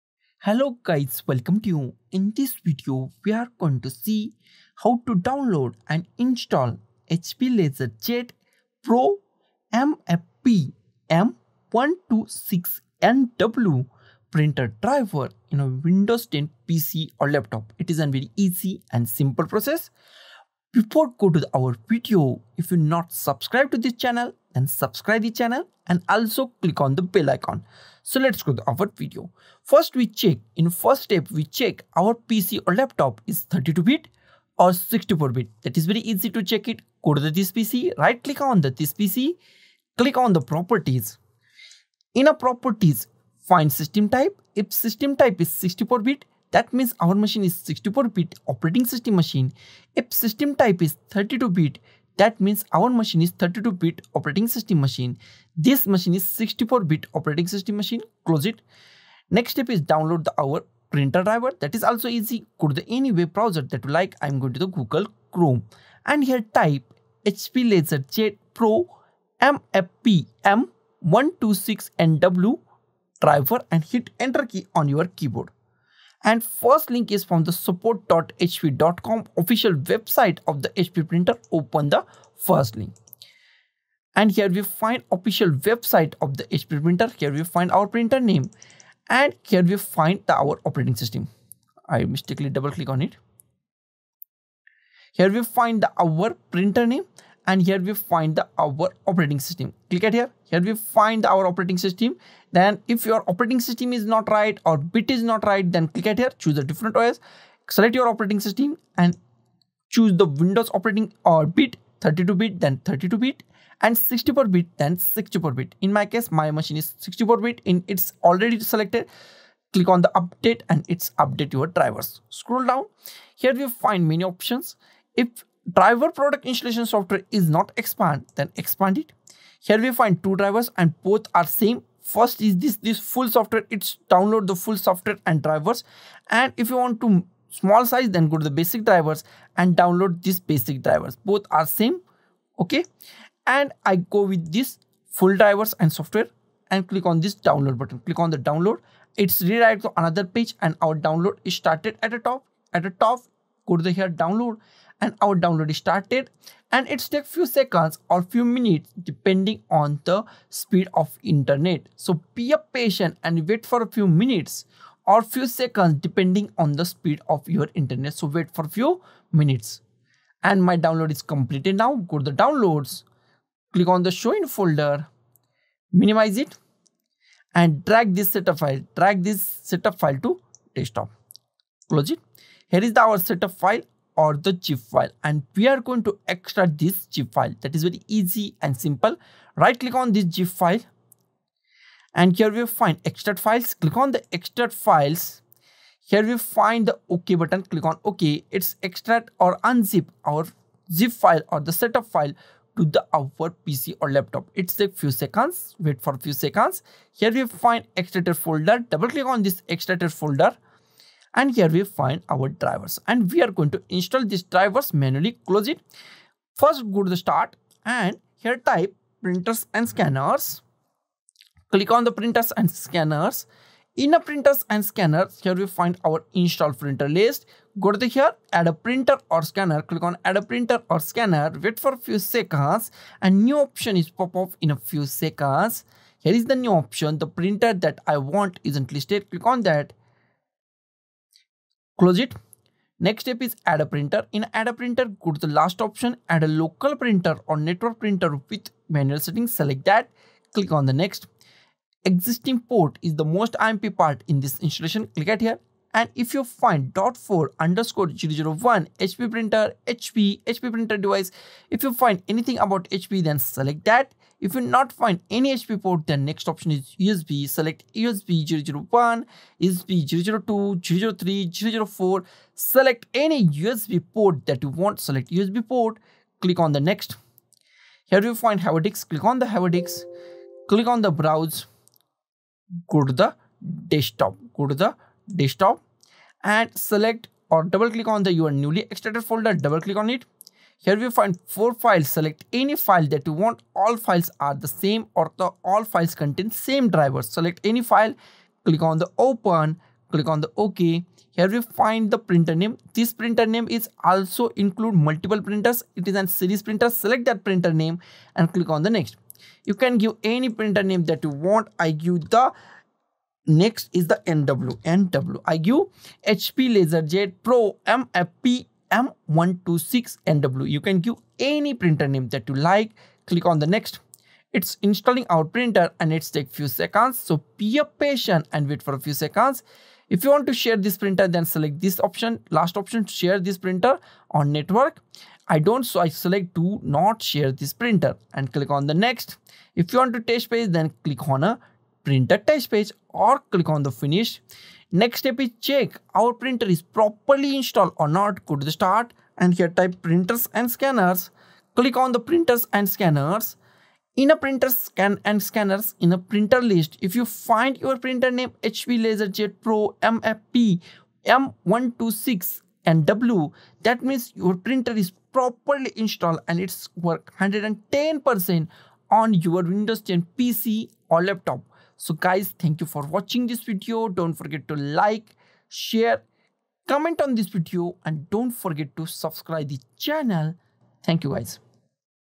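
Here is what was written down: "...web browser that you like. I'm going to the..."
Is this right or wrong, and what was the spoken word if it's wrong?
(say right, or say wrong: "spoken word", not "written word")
right.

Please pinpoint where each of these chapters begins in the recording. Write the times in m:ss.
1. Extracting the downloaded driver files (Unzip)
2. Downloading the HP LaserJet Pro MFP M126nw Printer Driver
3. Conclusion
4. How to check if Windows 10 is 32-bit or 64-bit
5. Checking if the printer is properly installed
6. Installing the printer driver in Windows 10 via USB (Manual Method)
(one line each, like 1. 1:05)
1. 3:02
2. 0:58
3. 6:11
4. 0:29
5. 5:44
6. 3:35.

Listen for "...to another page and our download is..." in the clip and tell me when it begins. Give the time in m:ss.
2:29.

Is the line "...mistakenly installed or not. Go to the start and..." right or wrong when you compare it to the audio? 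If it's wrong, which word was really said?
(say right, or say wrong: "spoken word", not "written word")
wrong: "properly", not "mistakenly".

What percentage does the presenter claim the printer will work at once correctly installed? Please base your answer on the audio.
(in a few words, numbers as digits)
110%.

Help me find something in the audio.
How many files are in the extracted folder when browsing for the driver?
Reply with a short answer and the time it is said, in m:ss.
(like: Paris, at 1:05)
4, at 4:51.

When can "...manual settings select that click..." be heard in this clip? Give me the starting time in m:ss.
4:08.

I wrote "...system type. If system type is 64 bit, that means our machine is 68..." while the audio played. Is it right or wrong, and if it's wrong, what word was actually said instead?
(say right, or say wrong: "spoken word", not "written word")
wrong: "64", not "68".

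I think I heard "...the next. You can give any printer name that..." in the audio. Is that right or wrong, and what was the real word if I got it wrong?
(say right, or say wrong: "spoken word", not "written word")
right.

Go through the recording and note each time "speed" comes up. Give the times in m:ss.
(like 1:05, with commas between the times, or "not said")
2:40, 2:46.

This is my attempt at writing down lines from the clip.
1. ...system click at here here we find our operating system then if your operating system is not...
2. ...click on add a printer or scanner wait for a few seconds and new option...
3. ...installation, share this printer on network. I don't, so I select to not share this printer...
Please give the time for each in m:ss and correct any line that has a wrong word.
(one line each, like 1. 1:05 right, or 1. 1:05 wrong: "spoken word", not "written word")
1. 1:39 right
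2. 3:49 right
3. 5:32 wrong: "option", not "installation".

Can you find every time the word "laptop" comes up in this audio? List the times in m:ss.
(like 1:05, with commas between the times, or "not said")
0:17, 0:32, 3:24, 6:11.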